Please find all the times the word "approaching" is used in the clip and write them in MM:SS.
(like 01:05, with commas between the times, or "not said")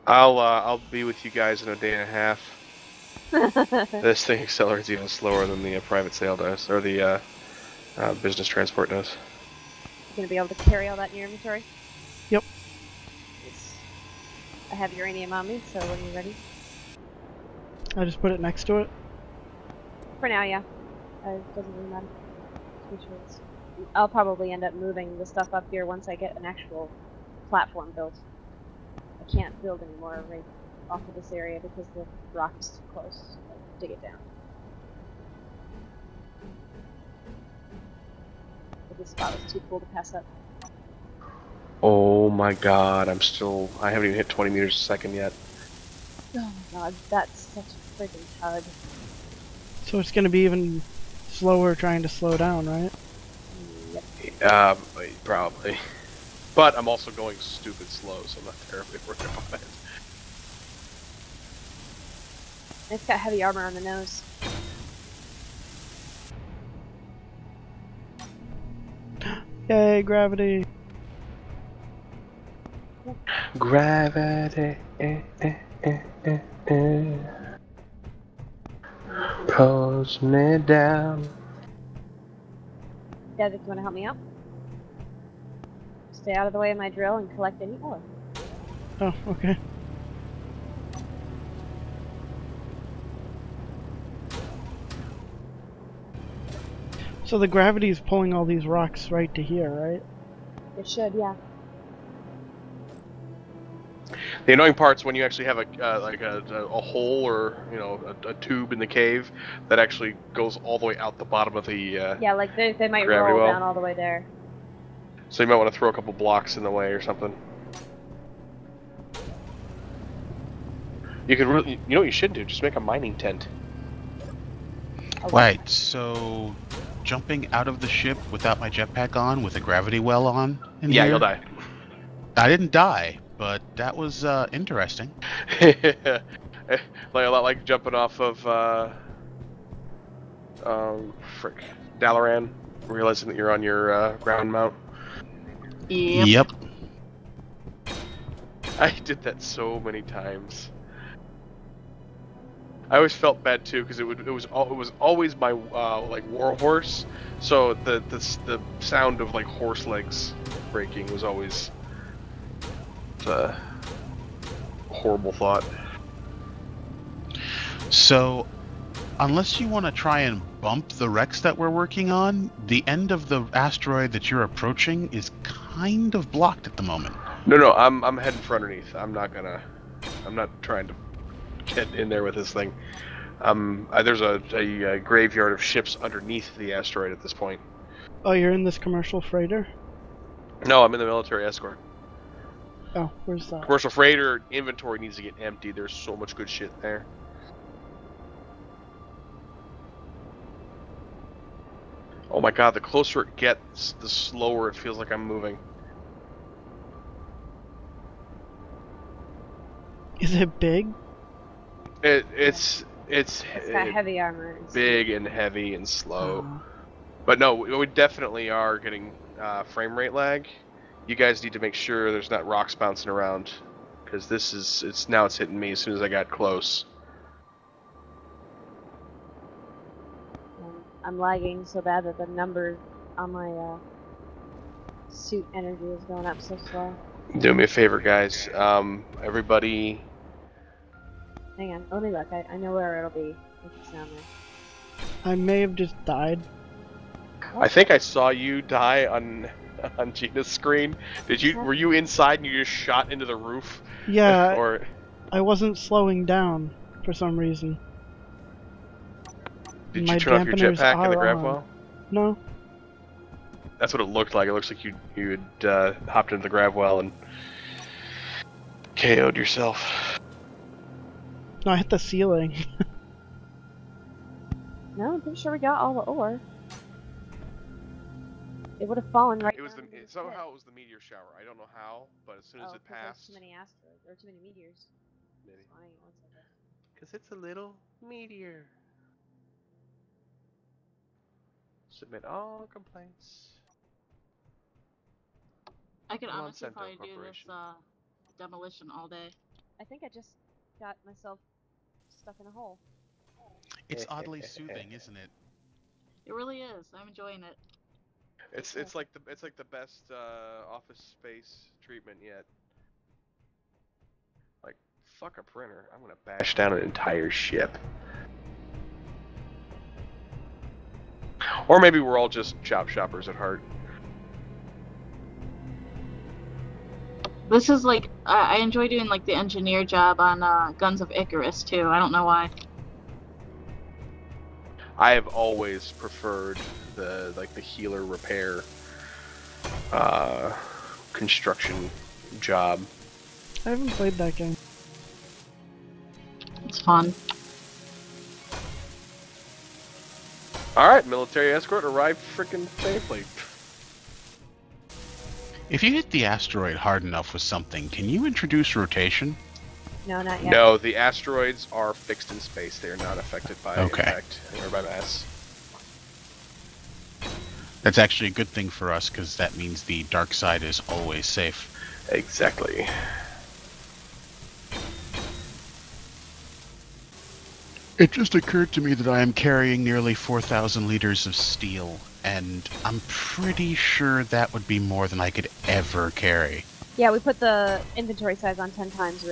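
02:54.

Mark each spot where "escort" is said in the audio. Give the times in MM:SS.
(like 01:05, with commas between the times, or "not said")
03:11, 05:51.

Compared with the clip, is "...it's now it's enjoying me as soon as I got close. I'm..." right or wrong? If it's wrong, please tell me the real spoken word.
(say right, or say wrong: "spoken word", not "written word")
wrong: "hitting", not "enjoying".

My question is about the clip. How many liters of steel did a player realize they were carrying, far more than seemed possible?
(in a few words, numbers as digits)
4,000.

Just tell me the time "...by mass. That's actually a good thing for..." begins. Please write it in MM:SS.
06:04.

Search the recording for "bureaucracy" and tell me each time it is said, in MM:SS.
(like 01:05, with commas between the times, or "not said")
not said.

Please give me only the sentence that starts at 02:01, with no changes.
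You could really, you know what you should do?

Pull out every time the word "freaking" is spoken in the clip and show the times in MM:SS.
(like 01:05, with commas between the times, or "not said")
00:48, 05:52.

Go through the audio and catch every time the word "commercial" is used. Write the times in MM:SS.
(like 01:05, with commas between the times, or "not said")
03:08, 03:13.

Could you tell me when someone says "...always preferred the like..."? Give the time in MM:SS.
05:35.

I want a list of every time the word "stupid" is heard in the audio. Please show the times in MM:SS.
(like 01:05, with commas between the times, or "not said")
00:57.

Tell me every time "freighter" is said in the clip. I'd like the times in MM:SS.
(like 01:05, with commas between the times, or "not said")
03:09, 03:13.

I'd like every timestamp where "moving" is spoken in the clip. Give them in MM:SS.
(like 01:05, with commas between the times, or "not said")
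00:24, 03:25.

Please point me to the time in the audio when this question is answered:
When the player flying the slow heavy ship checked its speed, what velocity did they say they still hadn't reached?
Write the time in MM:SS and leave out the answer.
00:44.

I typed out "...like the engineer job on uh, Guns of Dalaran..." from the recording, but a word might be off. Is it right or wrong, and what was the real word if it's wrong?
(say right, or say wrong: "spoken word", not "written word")
wrong: "Icarus", not "Dalaran".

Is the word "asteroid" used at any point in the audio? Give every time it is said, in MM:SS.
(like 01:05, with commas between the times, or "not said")
02:53, 03:06, 04:43, 05:56, 06:00.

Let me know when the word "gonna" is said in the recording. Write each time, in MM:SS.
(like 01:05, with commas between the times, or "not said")
00:10, 00:50, 02:59, 05:16.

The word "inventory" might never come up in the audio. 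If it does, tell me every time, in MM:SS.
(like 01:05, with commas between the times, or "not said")
00:11, 03:14, 06:27.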